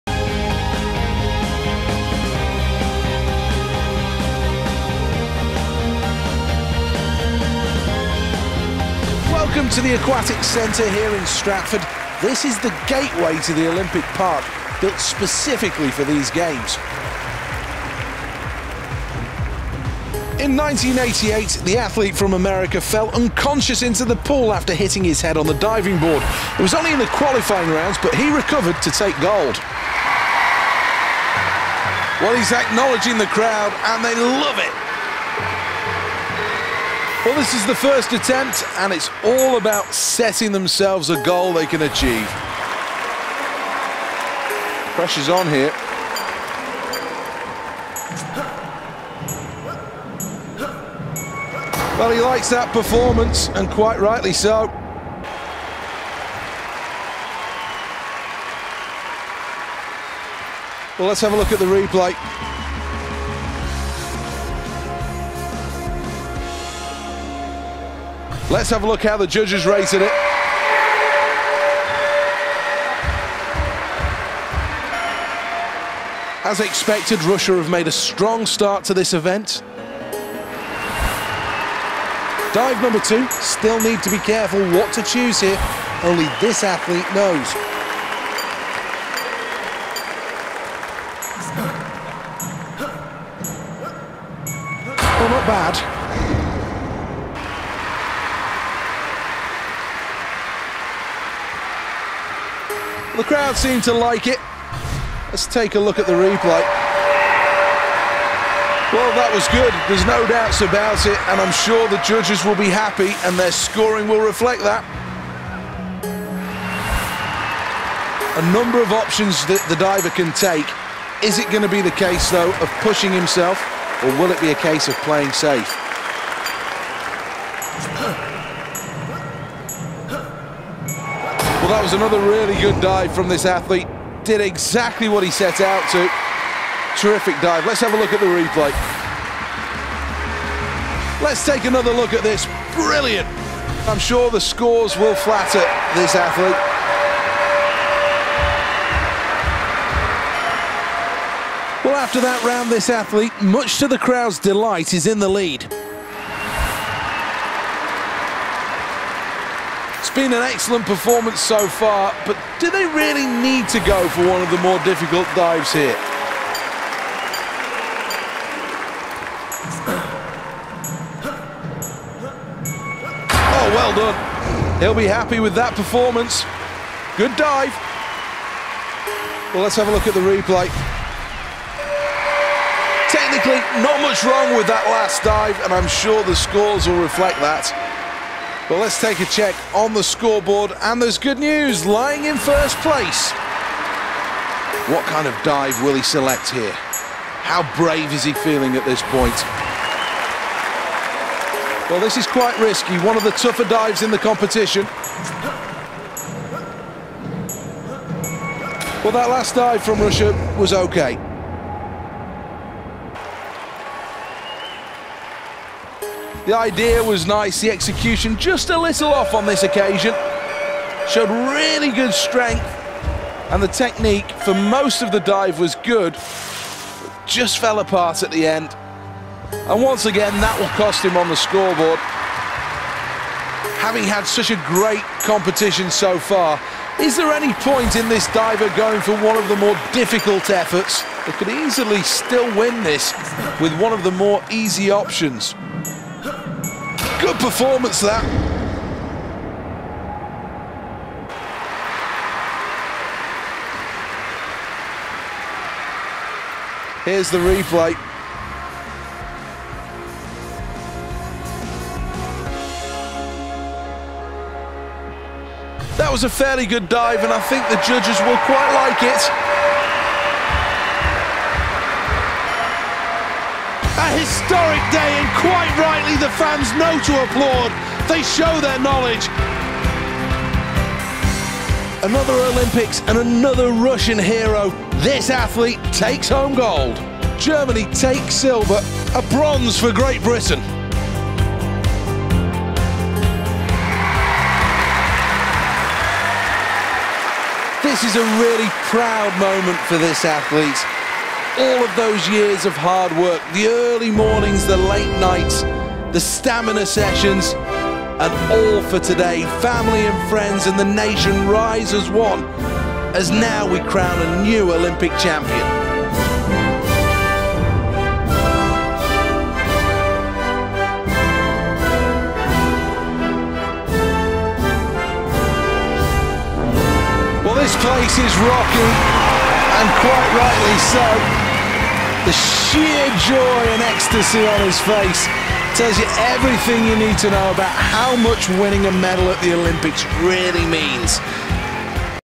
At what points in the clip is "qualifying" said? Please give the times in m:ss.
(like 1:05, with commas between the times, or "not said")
0:27.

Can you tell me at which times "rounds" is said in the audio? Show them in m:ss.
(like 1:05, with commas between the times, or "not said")
0:27, 2:32.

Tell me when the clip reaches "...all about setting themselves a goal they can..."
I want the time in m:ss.
0:39.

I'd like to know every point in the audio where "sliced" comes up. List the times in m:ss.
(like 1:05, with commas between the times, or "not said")
not said.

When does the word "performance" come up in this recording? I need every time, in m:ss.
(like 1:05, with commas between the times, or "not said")
0:52, 2:40, 2:55, 4:07.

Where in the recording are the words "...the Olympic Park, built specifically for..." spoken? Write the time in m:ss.
0:13.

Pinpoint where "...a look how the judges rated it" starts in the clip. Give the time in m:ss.
1:08.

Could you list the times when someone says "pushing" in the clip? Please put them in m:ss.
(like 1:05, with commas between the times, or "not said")
2:02.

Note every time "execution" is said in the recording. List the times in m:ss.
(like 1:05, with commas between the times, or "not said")
3:37.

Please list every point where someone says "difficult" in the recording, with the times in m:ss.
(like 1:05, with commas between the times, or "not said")
2:44, 3:59.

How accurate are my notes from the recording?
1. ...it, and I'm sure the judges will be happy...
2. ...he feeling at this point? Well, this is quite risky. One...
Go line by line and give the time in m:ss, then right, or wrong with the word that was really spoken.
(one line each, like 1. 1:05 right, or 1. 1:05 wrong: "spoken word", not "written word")
1. 1:51 right
2. 3:18 right.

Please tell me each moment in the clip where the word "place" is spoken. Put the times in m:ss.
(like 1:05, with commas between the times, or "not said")
3:12, 5:27.